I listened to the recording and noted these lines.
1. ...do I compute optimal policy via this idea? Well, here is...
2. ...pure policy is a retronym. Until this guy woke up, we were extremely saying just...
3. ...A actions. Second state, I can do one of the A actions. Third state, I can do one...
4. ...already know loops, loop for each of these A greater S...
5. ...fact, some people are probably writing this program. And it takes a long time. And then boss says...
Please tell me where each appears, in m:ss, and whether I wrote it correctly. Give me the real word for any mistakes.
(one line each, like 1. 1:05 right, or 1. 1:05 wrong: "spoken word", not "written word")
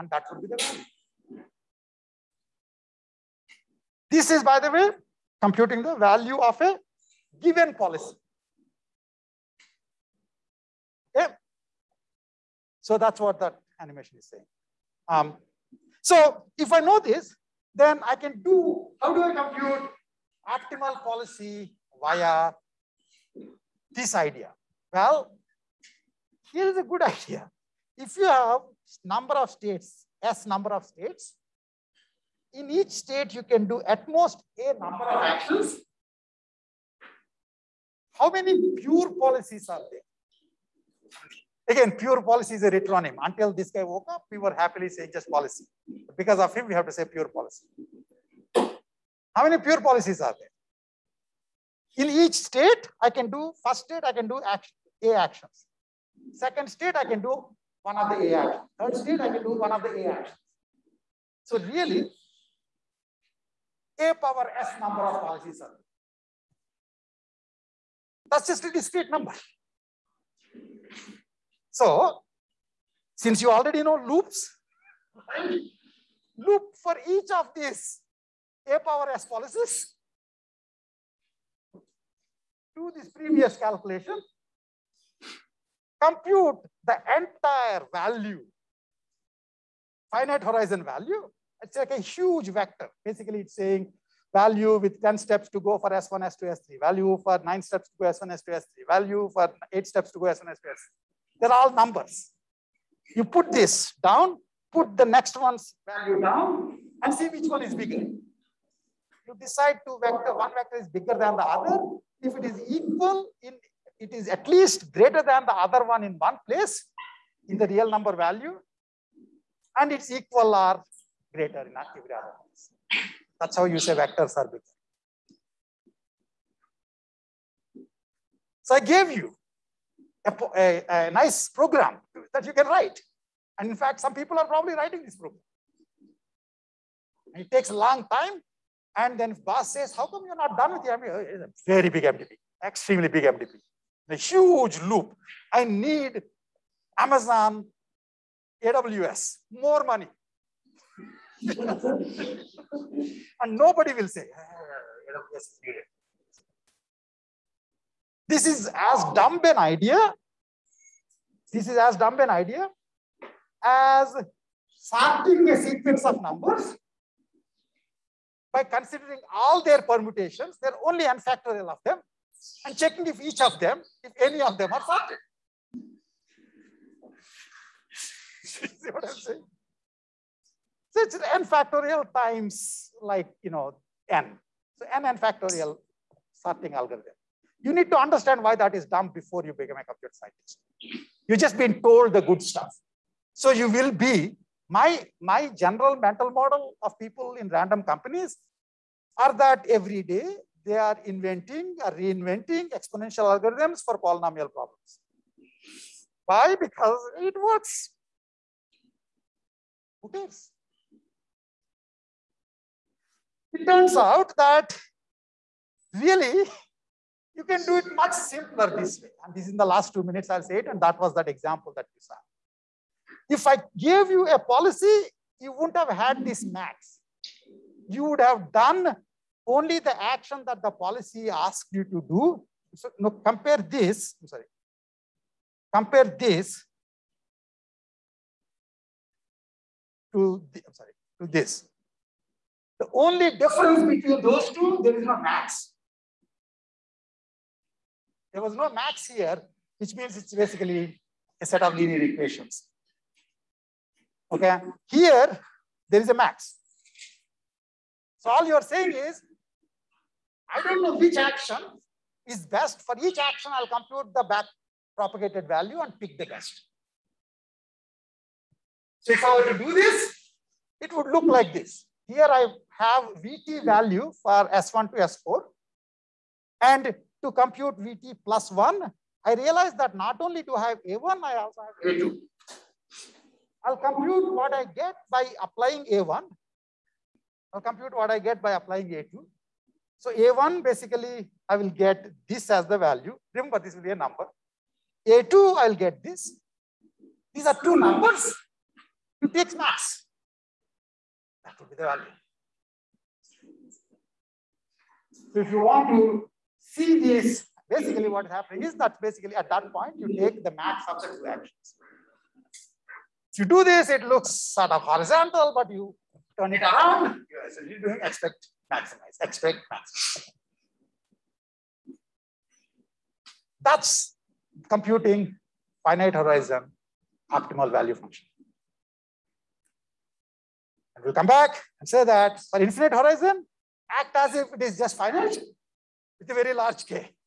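1. 0:19 right
2. 0:41 wrong: "happily", not "extremely"
3. 0:55 right
4. 1:13 wrong: "power", not "greater"
5. 2:13 right.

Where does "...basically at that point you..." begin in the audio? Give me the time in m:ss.
5:09.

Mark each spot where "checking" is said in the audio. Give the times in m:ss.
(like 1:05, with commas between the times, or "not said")
2:52.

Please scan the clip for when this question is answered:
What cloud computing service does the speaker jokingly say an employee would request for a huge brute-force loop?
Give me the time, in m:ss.
2:26.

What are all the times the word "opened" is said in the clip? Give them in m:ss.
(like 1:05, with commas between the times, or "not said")
not said.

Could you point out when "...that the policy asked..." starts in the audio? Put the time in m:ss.
3:50.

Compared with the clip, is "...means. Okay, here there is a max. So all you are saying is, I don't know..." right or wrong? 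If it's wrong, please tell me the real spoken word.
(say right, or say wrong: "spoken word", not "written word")
wrong: "equations", not "means".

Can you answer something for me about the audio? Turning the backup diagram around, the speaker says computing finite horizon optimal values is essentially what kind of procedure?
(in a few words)
expect max.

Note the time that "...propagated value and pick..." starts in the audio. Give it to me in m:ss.
4:24.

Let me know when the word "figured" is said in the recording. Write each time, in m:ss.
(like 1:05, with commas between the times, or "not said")
not said.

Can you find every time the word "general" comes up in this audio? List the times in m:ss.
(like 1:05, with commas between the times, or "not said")
3:15.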